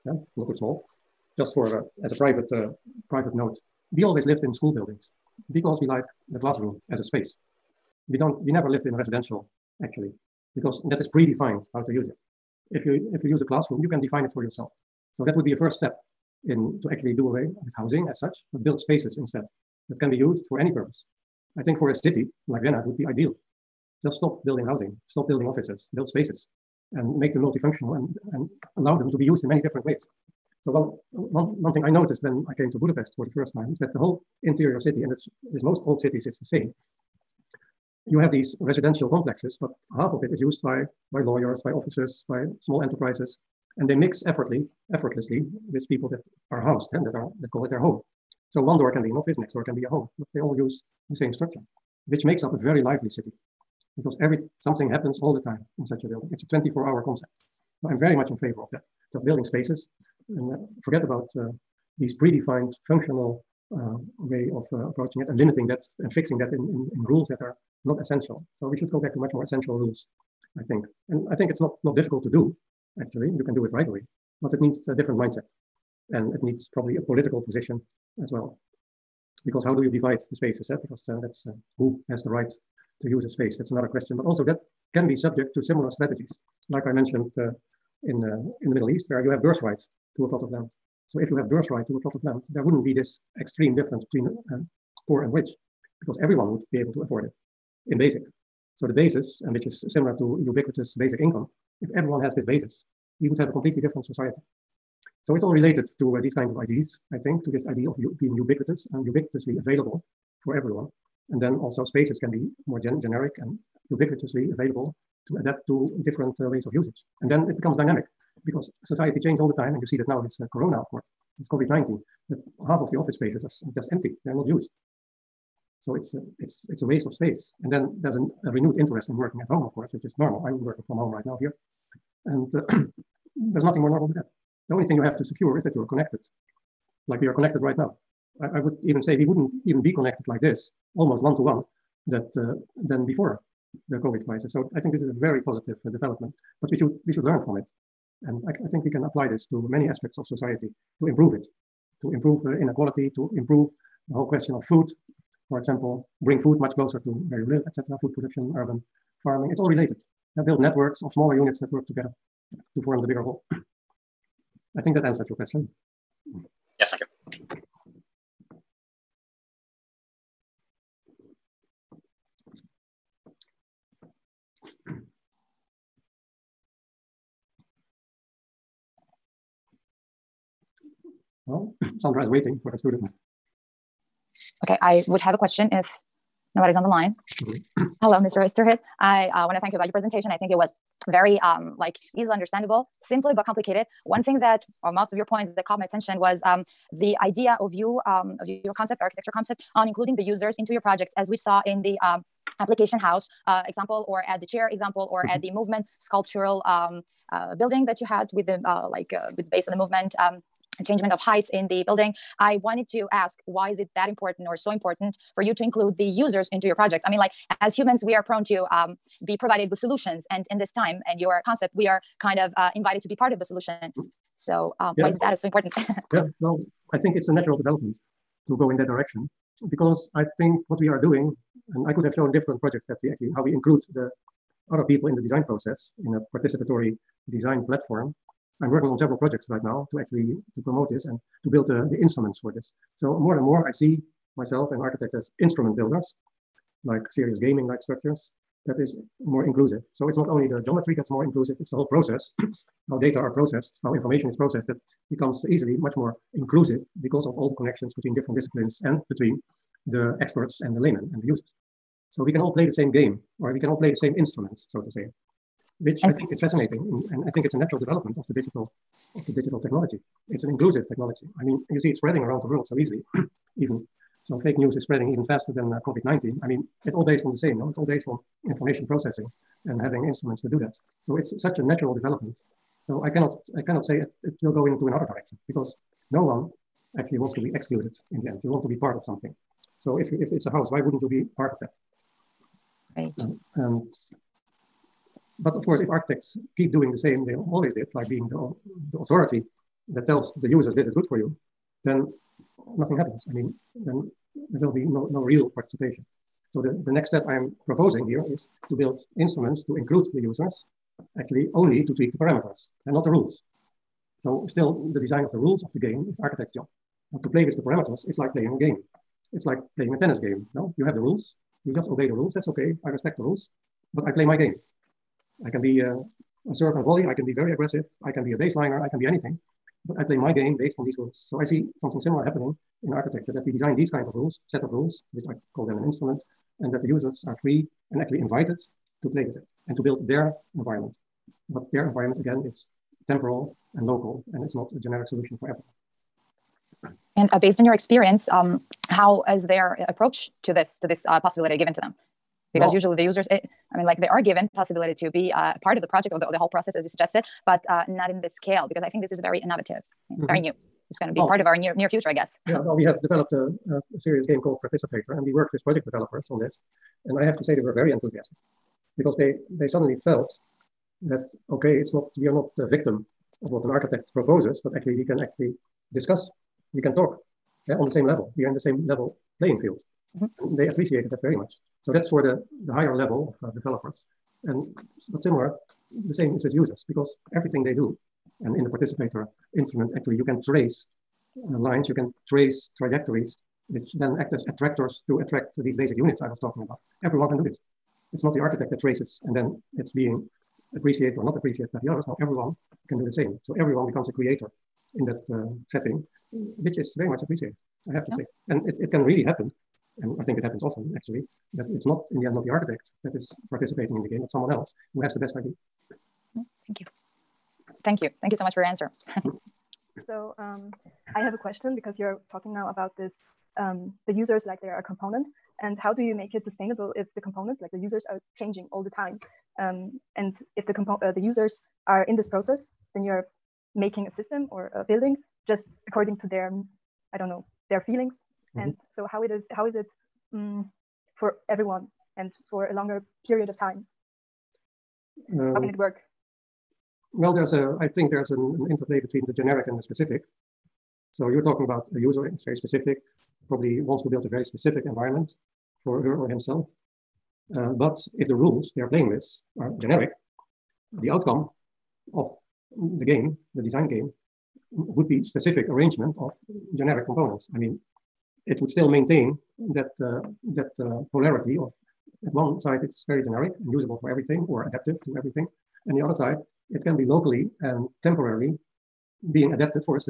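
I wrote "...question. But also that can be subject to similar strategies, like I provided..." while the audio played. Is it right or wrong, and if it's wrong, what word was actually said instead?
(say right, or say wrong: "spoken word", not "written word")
wrong: "mentioned", not "provided".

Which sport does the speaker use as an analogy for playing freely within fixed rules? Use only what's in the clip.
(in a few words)
Tennis.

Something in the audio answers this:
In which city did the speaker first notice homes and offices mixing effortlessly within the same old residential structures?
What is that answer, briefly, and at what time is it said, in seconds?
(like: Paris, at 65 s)
Budapest, at 32 s.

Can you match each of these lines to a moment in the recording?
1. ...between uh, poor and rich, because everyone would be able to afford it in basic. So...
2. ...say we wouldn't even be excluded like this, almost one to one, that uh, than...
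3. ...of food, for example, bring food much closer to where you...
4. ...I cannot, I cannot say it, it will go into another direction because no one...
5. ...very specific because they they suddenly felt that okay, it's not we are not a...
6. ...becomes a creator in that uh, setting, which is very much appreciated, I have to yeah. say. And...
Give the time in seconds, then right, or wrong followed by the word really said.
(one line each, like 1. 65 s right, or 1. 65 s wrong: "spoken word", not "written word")
1. 94 s right
2. 139 s wrong: "connected", not "excluded"
3. 154 s right
4. 283 s right
5. 367 s wrong: "enthusiastic", not "specific"
6. 403 s right.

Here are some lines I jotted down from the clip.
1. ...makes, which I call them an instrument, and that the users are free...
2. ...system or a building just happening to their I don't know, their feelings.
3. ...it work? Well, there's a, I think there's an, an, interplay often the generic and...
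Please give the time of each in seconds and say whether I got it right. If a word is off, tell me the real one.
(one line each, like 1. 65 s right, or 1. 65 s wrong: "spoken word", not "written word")
1. 334 s wrong: "rules", not "makes"
2. 434 s wrong: "according", not "happening"
3. 445 s wrong: "between", not "often".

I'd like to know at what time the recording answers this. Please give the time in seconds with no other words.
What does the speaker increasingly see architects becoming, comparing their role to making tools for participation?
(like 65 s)
245 s.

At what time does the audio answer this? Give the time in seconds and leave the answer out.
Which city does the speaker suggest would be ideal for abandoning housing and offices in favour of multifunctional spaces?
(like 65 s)
22 s.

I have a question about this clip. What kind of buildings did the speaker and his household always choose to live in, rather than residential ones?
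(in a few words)
School buildings.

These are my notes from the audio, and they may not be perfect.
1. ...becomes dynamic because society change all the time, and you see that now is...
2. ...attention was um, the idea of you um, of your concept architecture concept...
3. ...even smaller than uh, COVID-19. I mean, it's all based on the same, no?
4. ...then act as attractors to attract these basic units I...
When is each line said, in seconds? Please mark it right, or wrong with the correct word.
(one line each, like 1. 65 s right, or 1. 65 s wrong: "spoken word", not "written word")
1. 117 s right
2. 195 s right
3. 275 s wrong: "faster", not "smaller"
4. 393 s right.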